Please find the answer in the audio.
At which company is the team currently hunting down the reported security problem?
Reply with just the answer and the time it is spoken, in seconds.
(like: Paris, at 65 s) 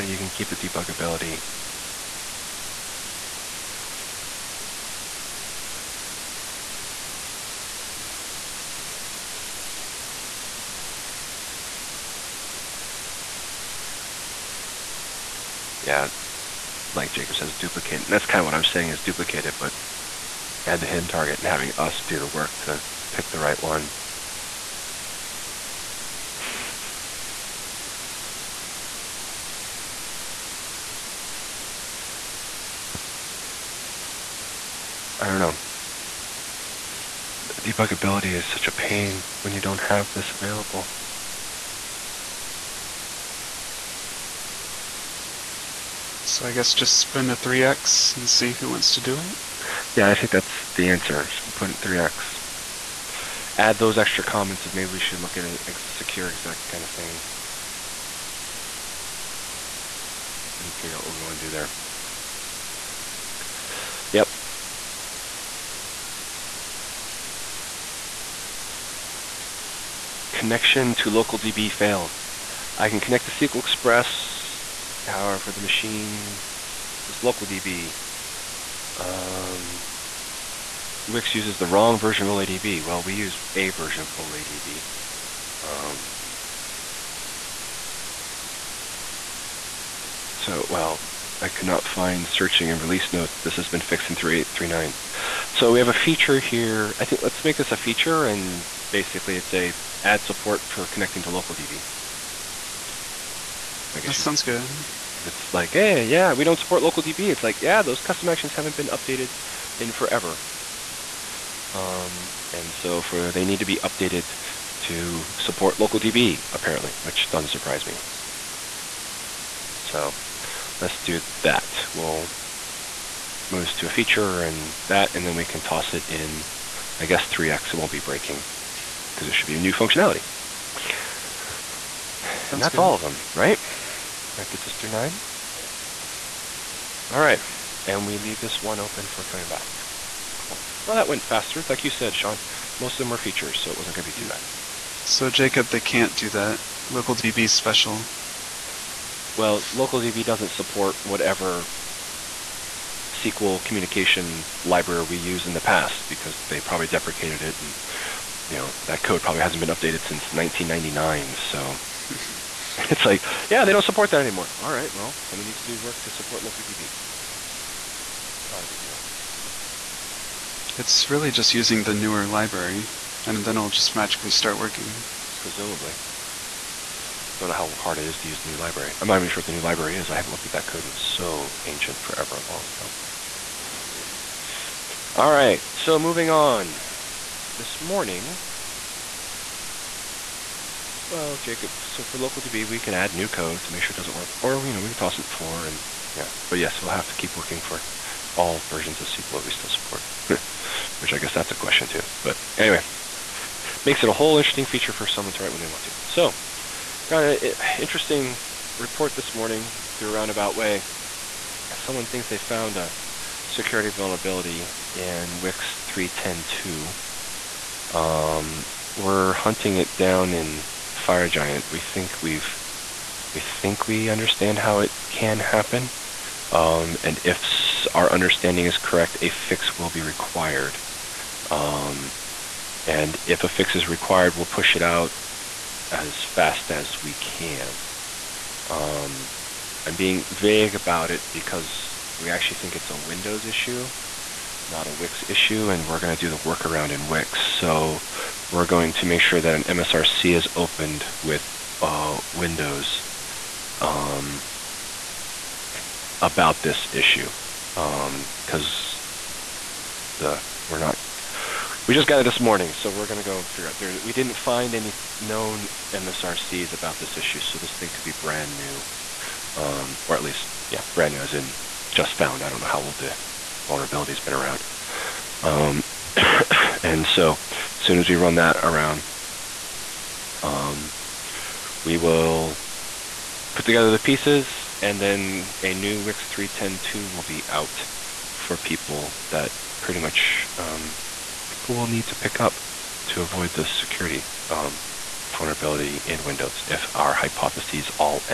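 FireGiant, at 221 s.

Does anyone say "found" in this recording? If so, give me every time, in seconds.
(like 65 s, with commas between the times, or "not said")
212 s, 272 s.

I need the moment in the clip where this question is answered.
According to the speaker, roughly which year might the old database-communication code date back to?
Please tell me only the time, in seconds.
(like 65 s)
160 s.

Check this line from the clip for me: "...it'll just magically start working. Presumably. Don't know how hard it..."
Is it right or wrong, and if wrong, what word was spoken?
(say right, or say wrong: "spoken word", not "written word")
right.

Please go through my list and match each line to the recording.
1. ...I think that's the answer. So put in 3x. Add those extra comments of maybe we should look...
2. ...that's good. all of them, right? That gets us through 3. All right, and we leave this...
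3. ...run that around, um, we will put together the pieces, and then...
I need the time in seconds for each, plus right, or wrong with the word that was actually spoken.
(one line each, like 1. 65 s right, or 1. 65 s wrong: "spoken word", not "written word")
1. 50 s right
2. 132 s wrong: "9", not "3"
3. 278 s right.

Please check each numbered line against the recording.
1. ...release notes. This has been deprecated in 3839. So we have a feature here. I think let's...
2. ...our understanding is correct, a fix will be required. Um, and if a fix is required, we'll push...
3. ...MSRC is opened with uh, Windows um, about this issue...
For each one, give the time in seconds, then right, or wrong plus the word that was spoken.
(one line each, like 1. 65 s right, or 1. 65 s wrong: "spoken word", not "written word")
1. 92 s wrong: "fixed", not "deprecated"
2. 227 s right
3. 249 s right.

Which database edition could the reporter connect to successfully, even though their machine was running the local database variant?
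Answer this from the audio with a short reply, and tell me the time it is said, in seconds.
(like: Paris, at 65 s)
SQL Express, at 73 s.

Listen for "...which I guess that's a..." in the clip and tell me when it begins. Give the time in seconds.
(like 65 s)
200 s.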